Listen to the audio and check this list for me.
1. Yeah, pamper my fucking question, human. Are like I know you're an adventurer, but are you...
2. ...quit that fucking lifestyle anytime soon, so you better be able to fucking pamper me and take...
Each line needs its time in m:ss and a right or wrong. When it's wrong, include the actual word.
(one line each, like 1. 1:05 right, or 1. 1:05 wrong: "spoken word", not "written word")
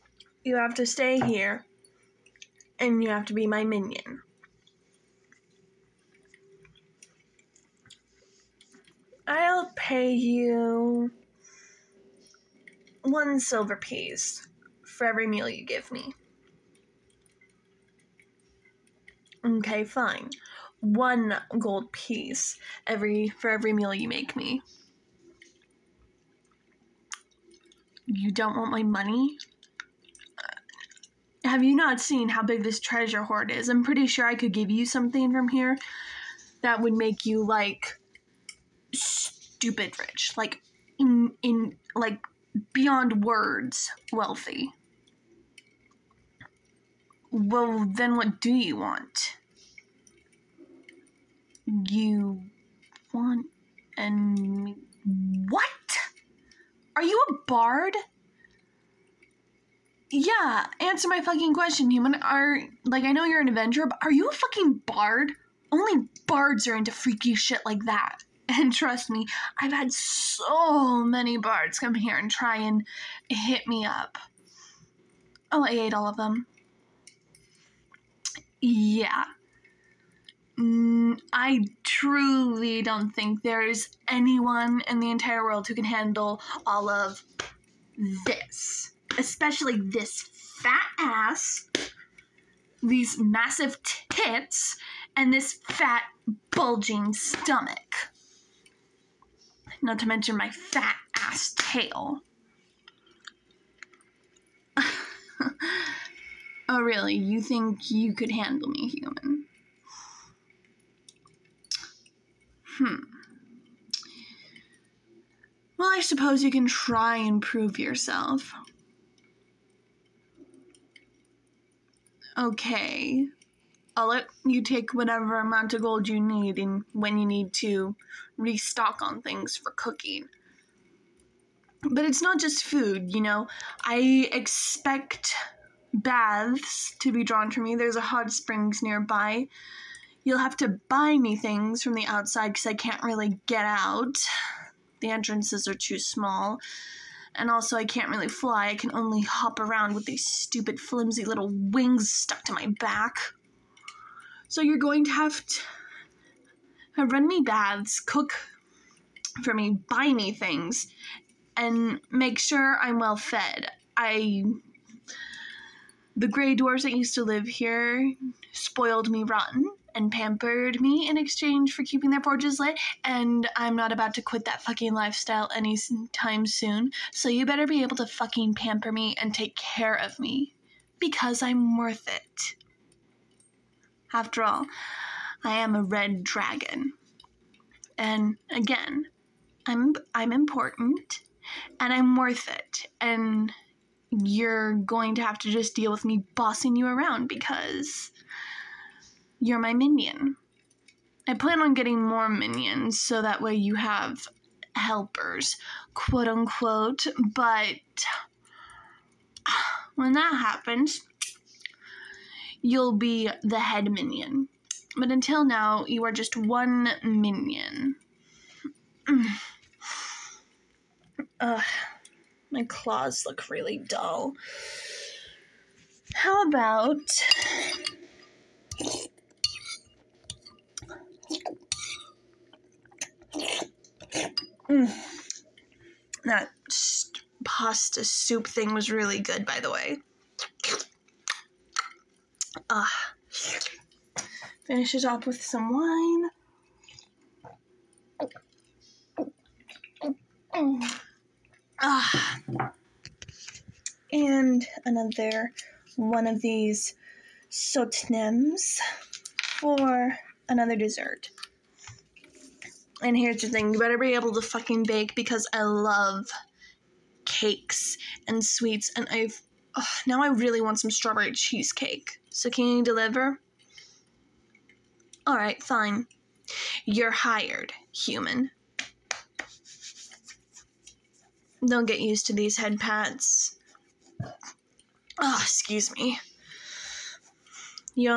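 1. 1:00 wrong: "answer", not "pamper"
2. 2:54 right.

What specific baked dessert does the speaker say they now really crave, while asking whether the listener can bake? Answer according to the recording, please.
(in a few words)
strawberry cheesecake.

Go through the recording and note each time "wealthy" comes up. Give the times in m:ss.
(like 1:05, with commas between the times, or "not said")
0:44.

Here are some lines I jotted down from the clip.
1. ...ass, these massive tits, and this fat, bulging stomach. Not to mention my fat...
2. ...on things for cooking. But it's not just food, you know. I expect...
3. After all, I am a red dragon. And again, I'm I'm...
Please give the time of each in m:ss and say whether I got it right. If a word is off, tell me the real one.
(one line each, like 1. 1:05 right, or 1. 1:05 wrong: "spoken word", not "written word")
1. 1:30 right
2. 2:09 right
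3. 3:04 right.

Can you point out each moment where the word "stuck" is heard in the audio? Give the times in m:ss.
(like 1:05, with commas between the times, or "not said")
2:32.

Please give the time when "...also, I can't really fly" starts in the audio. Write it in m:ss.
2:27.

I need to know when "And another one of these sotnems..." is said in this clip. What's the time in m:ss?
4:14.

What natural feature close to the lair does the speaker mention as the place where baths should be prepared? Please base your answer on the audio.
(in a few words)
hot springs.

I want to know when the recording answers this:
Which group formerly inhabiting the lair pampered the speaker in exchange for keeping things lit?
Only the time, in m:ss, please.
2:46.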